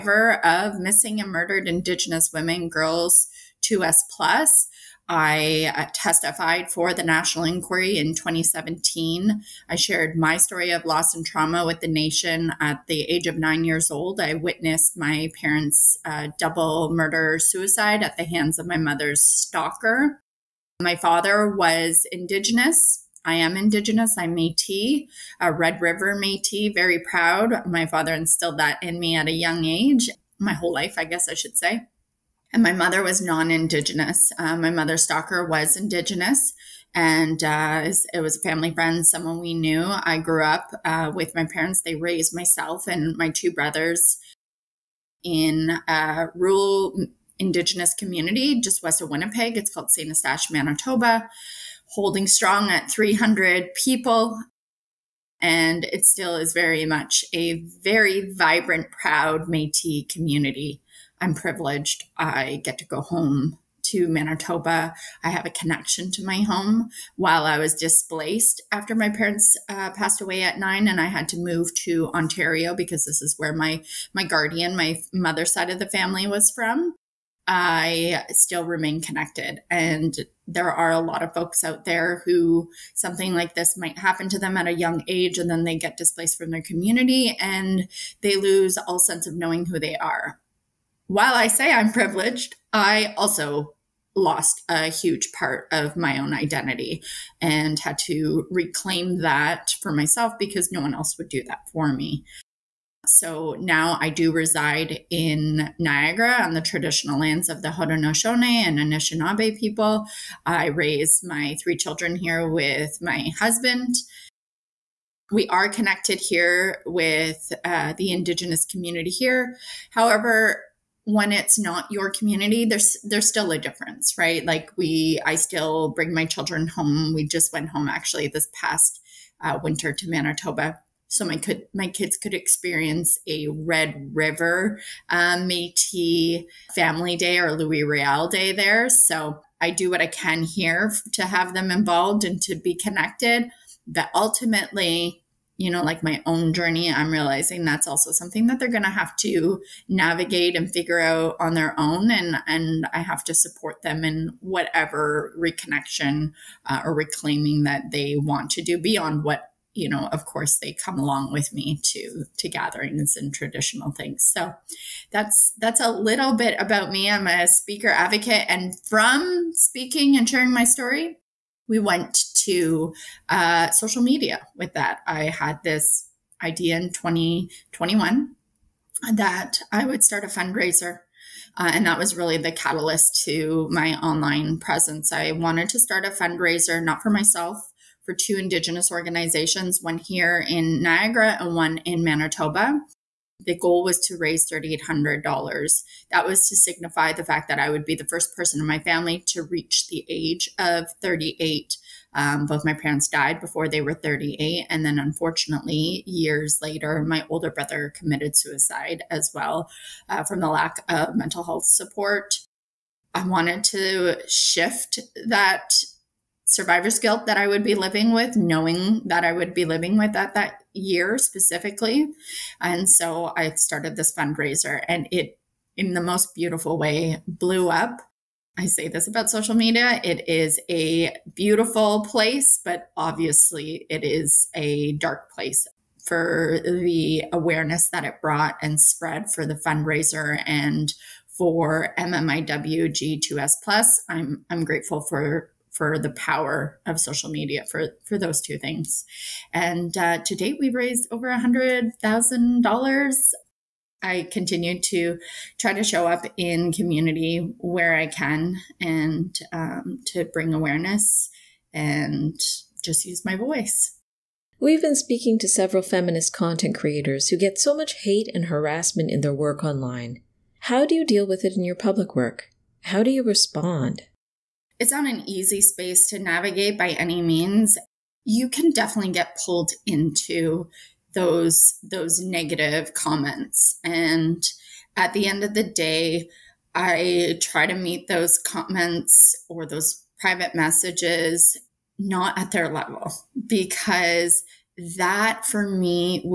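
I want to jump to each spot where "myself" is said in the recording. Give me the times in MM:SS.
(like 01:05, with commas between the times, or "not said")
00:42, 01:39, 03:07.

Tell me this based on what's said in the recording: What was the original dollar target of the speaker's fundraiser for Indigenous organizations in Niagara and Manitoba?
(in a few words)
$3,800.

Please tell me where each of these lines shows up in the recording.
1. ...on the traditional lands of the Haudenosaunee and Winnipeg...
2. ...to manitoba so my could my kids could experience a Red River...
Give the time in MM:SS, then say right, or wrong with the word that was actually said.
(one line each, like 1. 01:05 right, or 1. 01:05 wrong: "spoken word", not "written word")
1. 01:46 wrong: "Anishinaabe", not "Winnipeg"
2. 02:09 right.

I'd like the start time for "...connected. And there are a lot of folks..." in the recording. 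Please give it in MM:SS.
01:19.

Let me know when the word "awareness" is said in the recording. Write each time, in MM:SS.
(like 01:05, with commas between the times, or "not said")
03:57, 04:20.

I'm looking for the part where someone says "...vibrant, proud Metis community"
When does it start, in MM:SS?
00:58.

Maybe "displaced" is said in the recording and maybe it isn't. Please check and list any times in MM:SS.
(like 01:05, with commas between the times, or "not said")
01:07, 01:25.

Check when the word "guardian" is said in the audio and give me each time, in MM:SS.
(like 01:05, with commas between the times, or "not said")
01:14.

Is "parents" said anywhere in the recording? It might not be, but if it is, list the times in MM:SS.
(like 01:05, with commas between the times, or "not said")
00:15, 00:41, 01:09, 03:22.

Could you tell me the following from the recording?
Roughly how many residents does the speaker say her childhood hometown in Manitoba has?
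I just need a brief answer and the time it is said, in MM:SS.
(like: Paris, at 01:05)
300, at 00:52.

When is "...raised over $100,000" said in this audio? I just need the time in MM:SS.
04:10.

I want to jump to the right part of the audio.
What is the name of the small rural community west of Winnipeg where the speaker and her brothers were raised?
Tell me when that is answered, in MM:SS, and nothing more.
00:49.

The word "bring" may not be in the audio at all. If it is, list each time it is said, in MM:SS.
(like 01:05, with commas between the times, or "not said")
02:05, 04:20.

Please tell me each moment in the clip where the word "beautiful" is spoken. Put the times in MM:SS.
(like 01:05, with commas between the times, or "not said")
03:46, 03:51.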